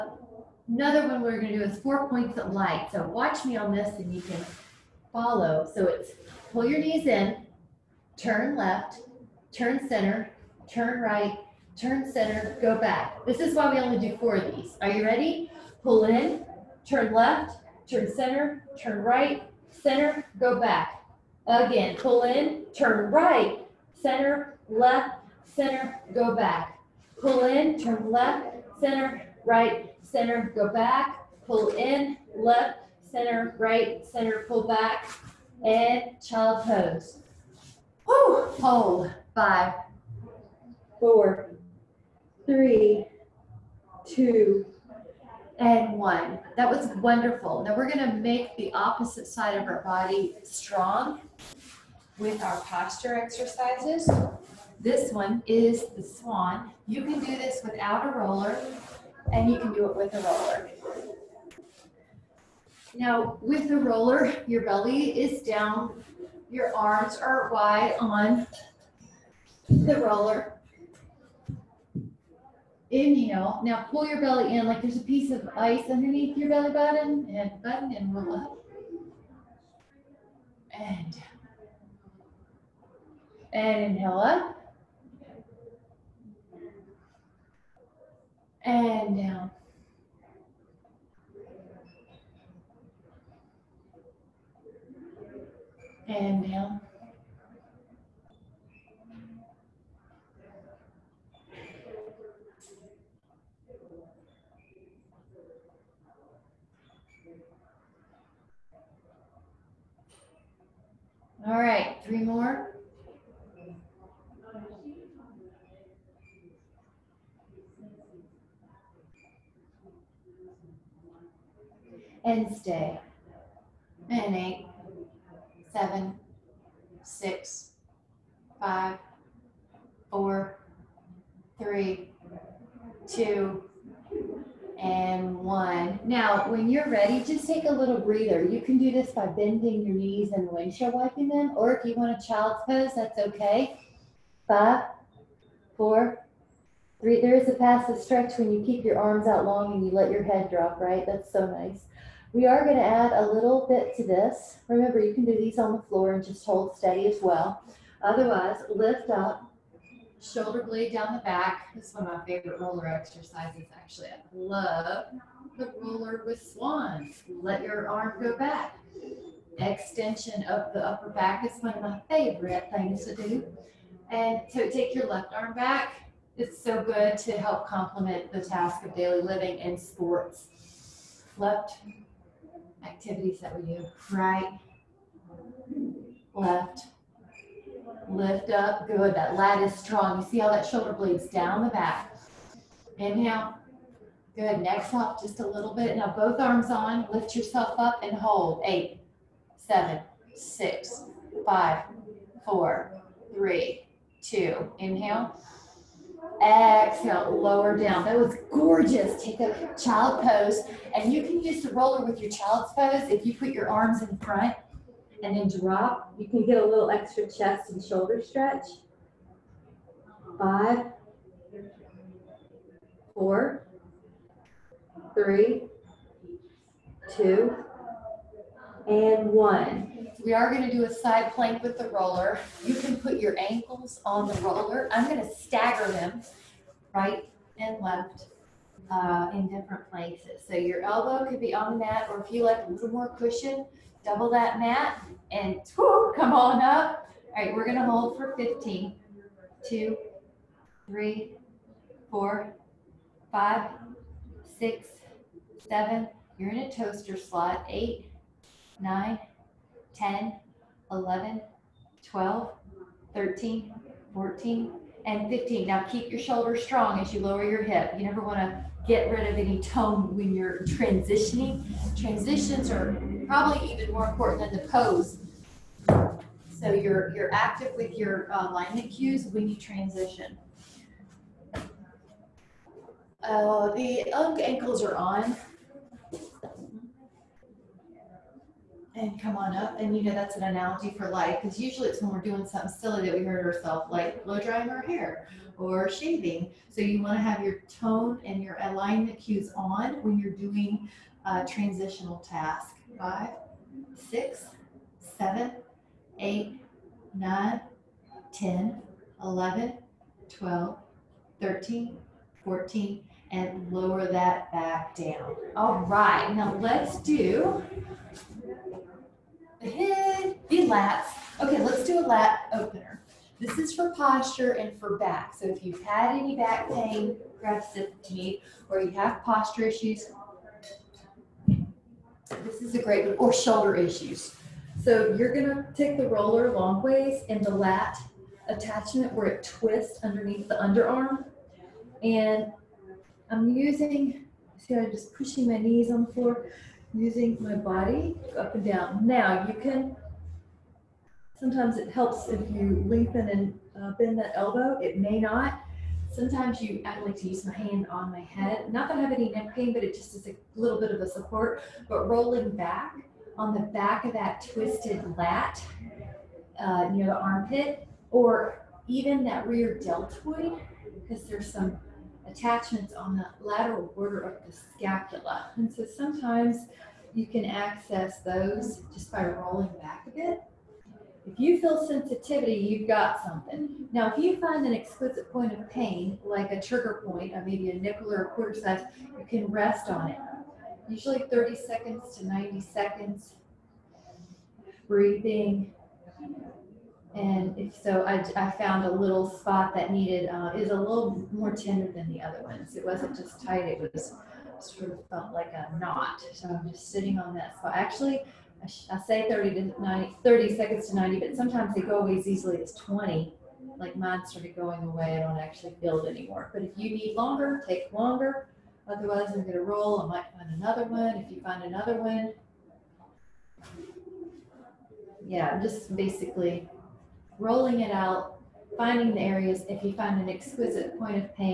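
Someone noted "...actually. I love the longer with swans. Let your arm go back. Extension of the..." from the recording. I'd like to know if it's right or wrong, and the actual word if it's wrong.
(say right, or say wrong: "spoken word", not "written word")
wrong: "roller", not "longer".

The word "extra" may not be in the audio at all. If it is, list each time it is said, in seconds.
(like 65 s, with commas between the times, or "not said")
216 s.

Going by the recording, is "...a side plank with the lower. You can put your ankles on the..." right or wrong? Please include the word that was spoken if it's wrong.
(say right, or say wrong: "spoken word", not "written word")
wrong: "roller", not "lower".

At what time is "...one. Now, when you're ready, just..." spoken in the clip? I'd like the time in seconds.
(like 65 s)
135 s.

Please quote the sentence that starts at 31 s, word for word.
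Pull in, left, center, right, center, pull back.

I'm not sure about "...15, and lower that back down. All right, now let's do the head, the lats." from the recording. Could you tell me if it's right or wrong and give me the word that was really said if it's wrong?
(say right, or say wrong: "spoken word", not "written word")
wrong: "14", not "15".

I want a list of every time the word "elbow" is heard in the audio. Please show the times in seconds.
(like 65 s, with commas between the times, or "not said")
240 s, 354 s.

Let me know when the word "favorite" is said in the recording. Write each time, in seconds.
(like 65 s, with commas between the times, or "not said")
162 s, 172 s.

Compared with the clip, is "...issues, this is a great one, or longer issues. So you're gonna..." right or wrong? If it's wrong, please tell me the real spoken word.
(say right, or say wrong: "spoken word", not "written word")
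wrong: "shoulder", not "longer".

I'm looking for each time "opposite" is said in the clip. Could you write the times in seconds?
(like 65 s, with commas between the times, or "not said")
48 s.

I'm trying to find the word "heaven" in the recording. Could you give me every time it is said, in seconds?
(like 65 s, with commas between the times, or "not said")
not said.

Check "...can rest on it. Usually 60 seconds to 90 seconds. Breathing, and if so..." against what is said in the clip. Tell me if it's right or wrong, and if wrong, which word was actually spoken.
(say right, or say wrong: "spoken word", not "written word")
wrong: "30", not "60".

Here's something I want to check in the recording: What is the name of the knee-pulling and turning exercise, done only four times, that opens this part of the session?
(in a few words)
Four points of light.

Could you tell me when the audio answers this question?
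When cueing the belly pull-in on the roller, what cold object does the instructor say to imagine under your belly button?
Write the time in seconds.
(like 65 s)
74 s.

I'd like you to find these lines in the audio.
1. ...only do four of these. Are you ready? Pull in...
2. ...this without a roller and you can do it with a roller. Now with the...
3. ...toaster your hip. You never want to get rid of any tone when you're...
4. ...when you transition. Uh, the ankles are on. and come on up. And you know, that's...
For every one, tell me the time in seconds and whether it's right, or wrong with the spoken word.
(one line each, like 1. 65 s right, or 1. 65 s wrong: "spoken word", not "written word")
1. 13 s right
2. 57 s right
3. 267 s wrong: "lower", not "toaster"
4. 279 s right.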